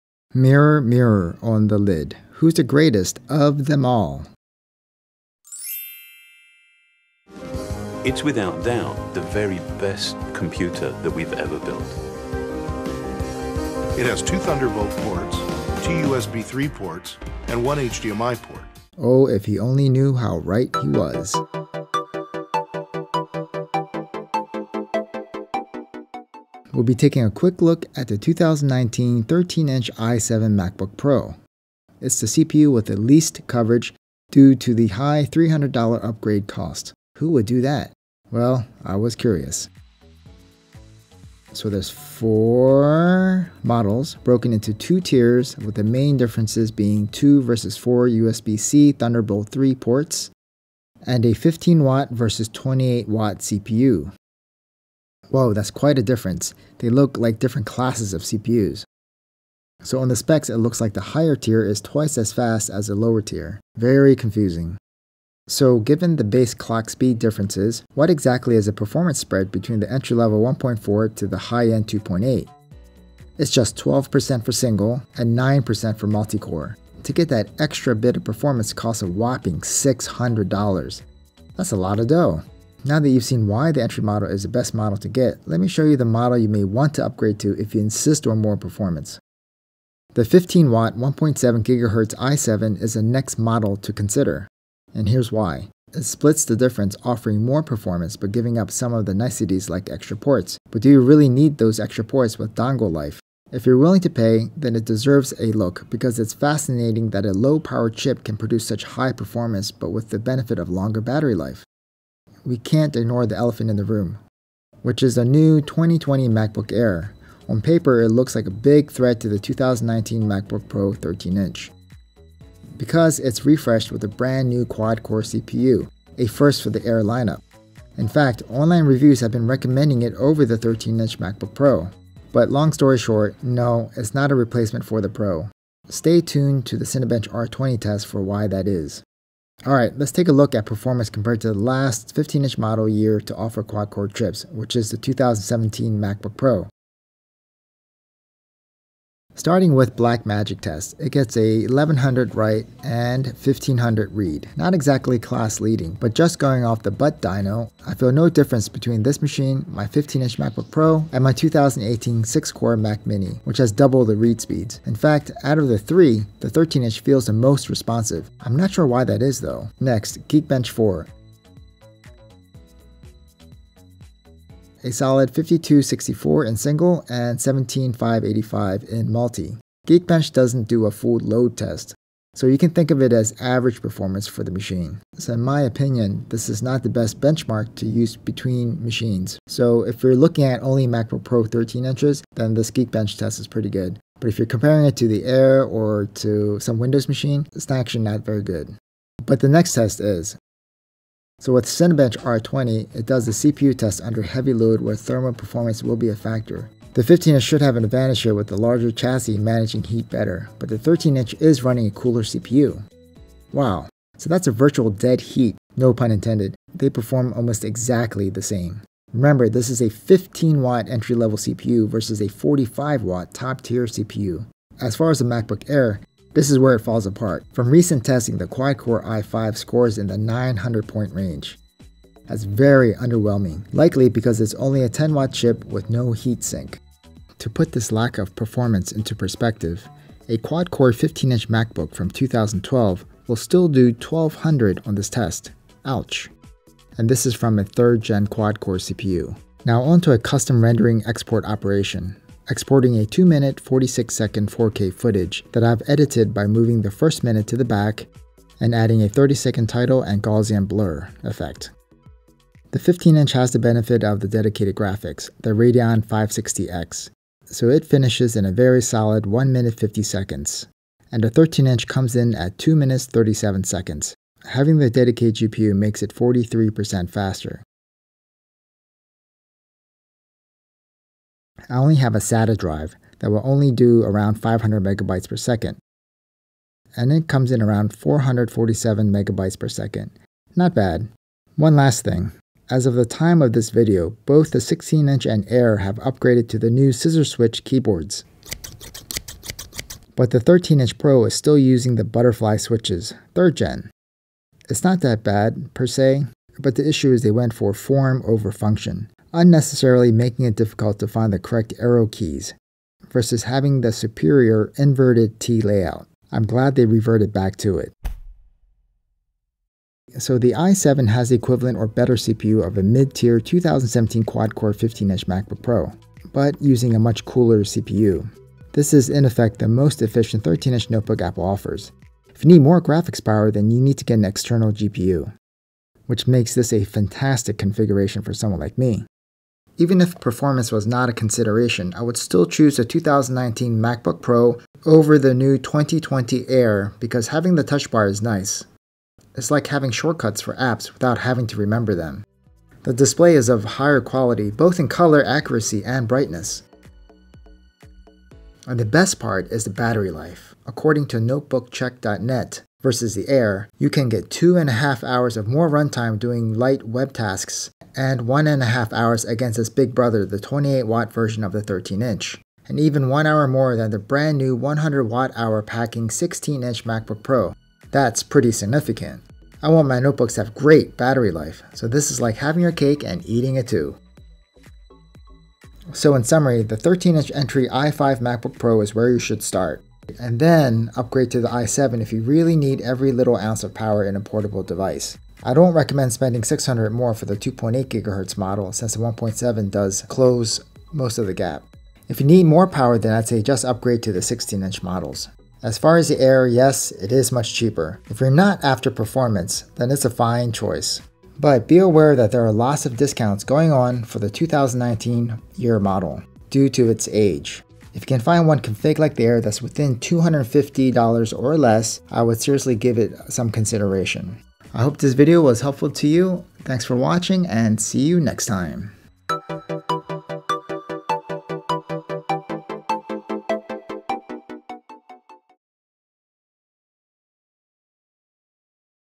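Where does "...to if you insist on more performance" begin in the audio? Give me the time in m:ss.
1:27.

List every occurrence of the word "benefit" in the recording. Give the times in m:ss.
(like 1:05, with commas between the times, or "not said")
1:50, 4:23.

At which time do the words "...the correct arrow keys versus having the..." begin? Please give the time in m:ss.
5:11.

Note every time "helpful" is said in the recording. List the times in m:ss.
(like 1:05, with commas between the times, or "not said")
7:05.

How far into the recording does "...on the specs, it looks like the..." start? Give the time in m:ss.
0:59.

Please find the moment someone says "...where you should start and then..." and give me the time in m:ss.
6:28.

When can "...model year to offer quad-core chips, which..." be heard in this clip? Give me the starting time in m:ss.
2:22.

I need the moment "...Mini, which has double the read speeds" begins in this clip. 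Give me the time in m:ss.
2:43.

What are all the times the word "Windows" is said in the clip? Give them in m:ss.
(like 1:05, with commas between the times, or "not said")
3:16.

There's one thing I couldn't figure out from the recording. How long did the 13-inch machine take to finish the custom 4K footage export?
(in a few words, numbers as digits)
2 minutes 37 seconds.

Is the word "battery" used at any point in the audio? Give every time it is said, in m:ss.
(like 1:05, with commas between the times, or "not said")
1:51, 5:59, 6:20.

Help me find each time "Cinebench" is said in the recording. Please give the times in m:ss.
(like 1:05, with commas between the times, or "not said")
2:16, 3:21.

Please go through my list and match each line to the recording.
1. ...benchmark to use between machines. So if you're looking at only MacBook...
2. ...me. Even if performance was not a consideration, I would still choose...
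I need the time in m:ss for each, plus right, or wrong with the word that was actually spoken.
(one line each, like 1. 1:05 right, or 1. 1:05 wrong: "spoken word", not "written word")
1. 3:07 right
2. 5:38 right.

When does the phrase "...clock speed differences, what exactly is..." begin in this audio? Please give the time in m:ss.
1:06.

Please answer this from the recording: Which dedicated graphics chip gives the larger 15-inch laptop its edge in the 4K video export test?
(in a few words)
Radeon 560X.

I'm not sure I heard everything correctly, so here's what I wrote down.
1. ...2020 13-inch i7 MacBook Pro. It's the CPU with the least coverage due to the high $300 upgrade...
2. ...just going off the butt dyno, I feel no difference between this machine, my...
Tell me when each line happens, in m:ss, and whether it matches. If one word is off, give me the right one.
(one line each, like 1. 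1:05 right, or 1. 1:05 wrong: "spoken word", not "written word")
1. 0:28 wrong: "2019", not "2020"
2. 2:36 right.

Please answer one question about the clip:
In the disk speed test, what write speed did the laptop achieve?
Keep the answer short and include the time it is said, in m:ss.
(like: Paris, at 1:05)
1100, at 2:31.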